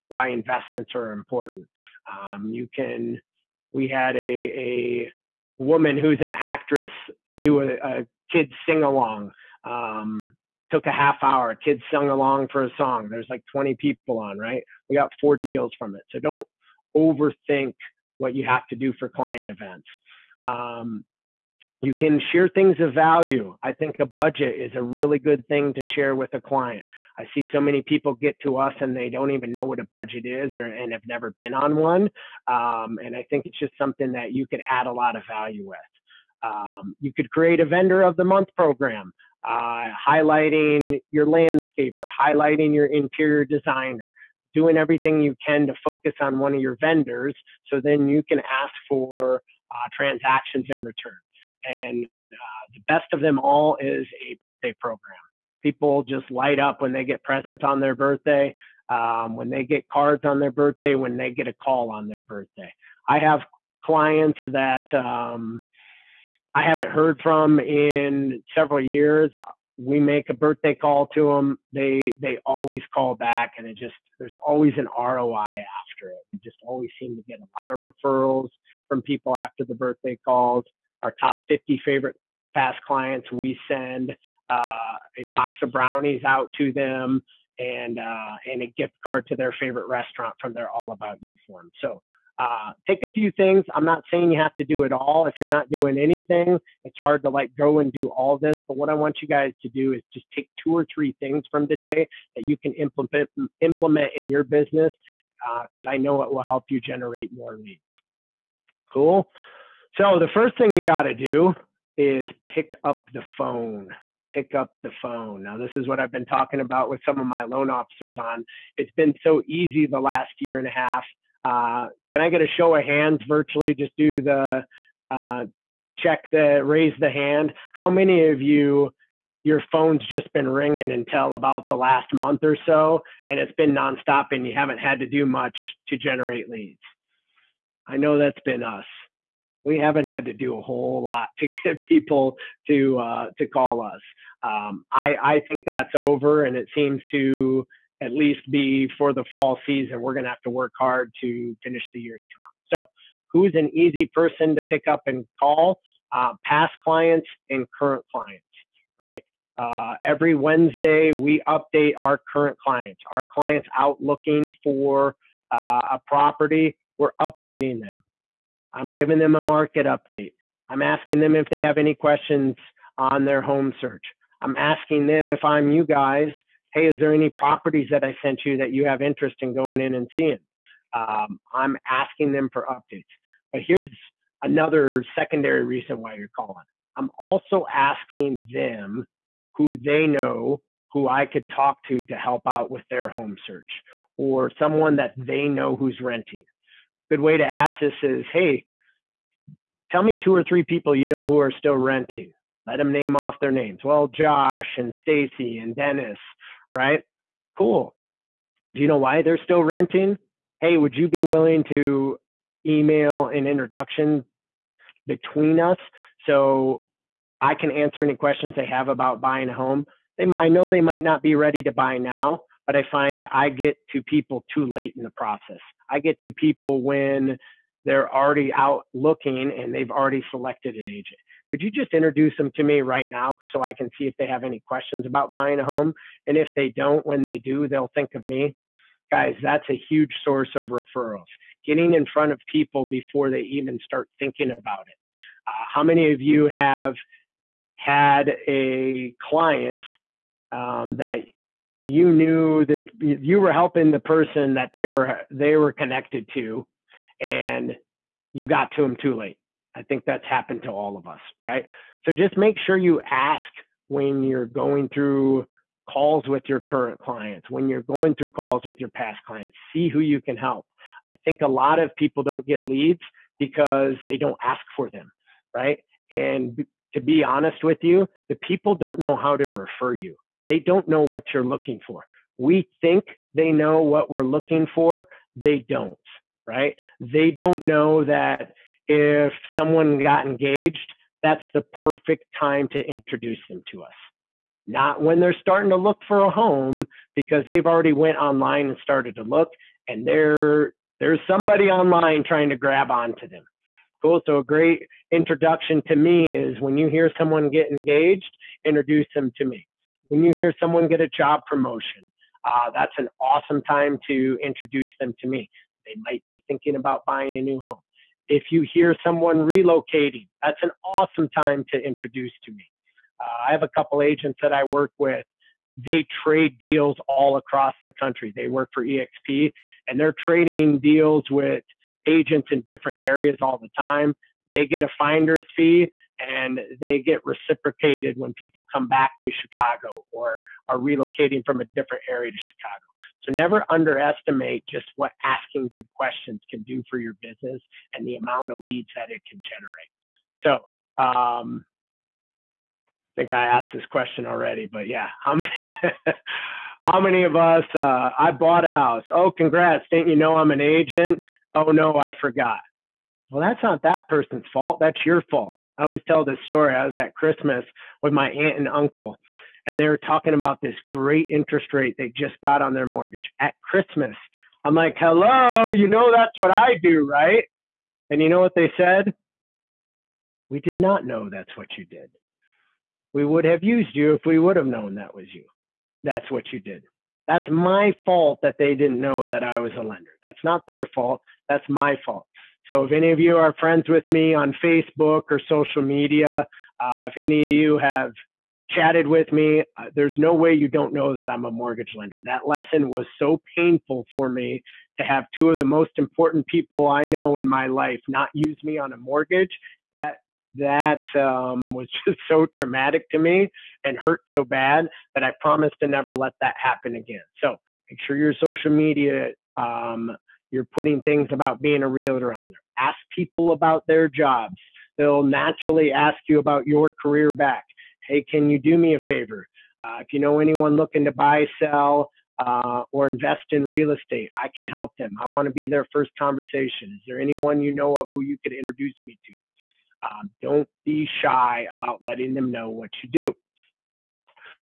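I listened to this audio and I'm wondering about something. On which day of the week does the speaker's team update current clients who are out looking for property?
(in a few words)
Wednesday.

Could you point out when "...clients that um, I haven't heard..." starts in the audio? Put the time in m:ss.
1:03.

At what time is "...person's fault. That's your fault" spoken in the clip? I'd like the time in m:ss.
6:04.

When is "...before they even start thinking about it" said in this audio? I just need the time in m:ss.
4:02.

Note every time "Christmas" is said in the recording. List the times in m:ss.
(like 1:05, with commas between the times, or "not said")
6:07, 6:13.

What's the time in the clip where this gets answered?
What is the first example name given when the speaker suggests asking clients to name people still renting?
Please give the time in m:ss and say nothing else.
3:24.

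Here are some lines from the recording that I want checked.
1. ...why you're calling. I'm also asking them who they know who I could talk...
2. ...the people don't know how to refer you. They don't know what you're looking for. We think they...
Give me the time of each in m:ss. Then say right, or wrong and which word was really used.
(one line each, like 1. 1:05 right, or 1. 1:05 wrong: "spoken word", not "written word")
1. 3:05 right
2. 4:38 right.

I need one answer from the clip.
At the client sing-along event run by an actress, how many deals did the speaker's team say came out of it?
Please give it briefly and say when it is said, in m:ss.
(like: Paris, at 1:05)
4, at 0:15.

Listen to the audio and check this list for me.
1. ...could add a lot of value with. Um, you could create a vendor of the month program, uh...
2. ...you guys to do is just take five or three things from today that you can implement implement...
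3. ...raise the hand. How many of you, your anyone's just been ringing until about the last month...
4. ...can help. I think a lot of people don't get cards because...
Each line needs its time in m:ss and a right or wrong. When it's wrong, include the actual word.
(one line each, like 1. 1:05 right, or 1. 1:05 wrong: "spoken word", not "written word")
1. 0:34 right
2. 1:39 wrong: "two", not "five"
3. 2:06 wrong: "phone", not "anyone"
4. 4:30 wrong: "leads", not "cards".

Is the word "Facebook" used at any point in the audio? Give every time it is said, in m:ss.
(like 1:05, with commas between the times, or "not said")
6:34.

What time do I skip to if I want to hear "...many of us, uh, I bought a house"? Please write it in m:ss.
5:57.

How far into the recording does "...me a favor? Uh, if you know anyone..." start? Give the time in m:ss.
7:08.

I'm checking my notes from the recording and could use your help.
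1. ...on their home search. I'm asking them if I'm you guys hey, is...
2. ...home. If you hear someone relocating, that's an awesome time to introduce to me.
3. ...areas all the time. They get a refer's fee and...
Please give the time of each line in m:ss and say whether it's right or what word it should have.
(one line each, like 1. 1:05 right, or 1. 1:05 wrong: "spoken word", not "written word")
1. 2:52 right
2. 5:17 right
3. 5:33 wrong: "finder", not "refer".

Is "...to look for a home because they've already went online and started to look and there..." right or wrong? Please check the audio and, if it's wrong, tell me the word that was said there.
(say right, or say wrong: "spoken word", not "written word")
right.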